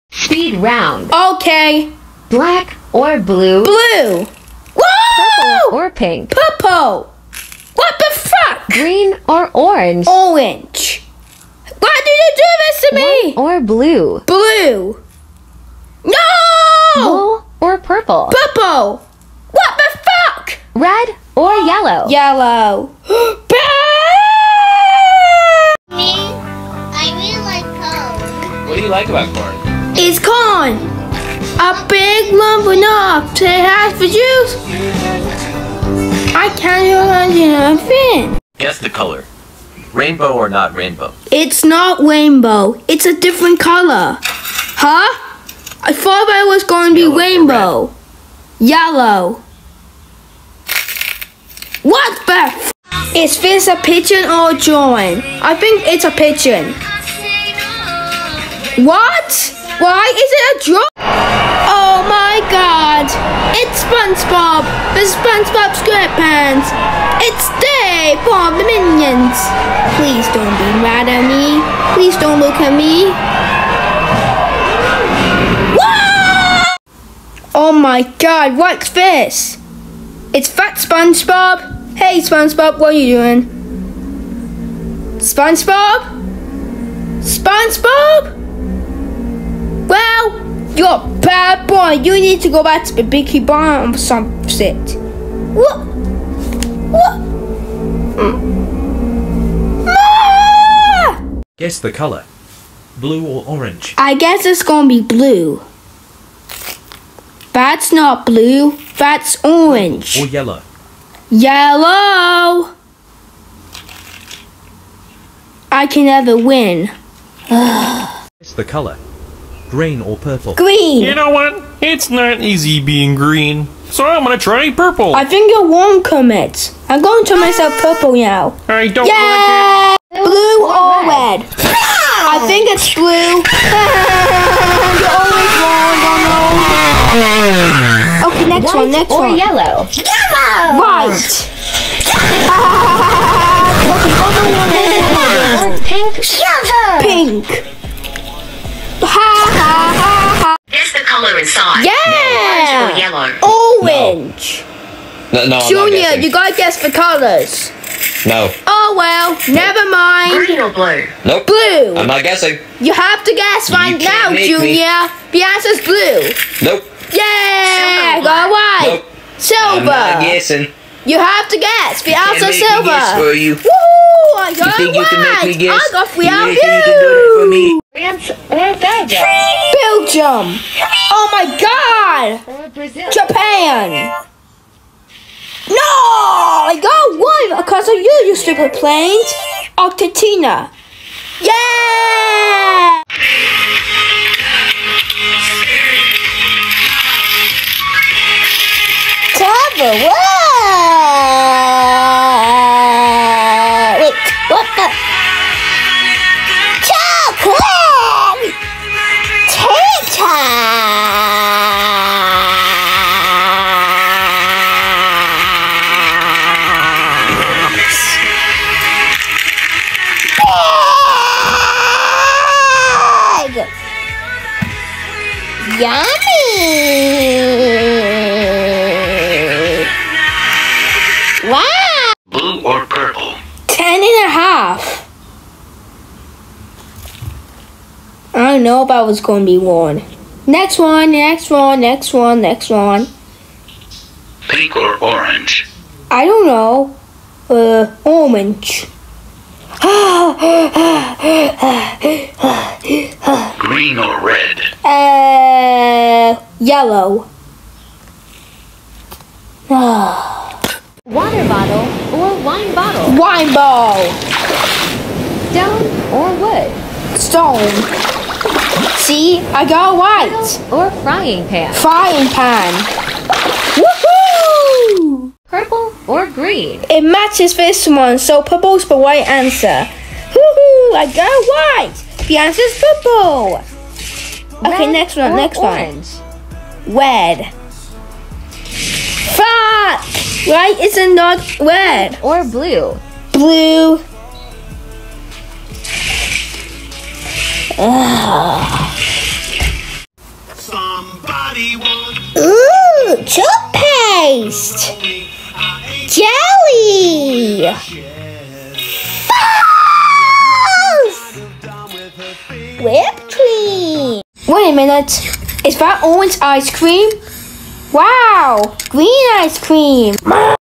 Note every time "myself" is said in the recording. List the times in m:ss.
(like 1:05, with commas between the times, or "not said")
2:07.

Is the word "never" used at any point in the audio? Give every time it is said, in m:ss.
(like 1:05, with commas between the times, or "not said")
1:56, 2:39.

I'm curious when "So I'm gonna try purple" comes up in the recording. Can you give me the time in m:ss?
2:03.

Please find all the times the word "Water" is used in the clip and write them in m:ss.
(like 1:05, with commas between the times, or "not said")
4:19.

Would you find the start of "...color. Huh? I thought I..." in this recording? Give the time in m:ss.
0:43.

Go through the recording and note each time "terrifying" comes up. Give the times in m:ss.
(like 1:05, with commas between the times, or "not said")
not said.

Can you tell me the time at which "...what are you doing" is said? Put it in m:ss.
1:22.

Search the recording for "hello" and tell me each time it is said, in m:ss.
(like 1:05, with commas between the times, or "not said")
not said.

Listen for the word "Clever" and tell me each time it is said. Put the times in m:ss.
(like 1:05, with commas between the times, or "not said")
3:19.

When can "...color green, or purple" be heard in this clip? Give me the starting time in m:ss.
1:58.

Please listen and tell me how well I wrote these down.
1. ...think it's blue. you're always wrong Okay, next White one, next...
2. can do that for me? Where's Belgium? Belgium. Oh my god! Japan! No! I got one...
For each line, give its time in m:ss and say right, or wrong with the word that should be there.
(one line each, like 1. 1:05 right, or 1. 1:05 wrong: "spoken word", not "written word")
1. 2:12 right
2. 2:56 right.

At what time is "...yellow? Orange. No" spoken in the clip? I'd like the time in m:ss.
2:32.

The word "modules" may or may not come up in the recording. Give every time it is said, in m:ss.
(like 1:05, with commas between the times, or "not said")
not said.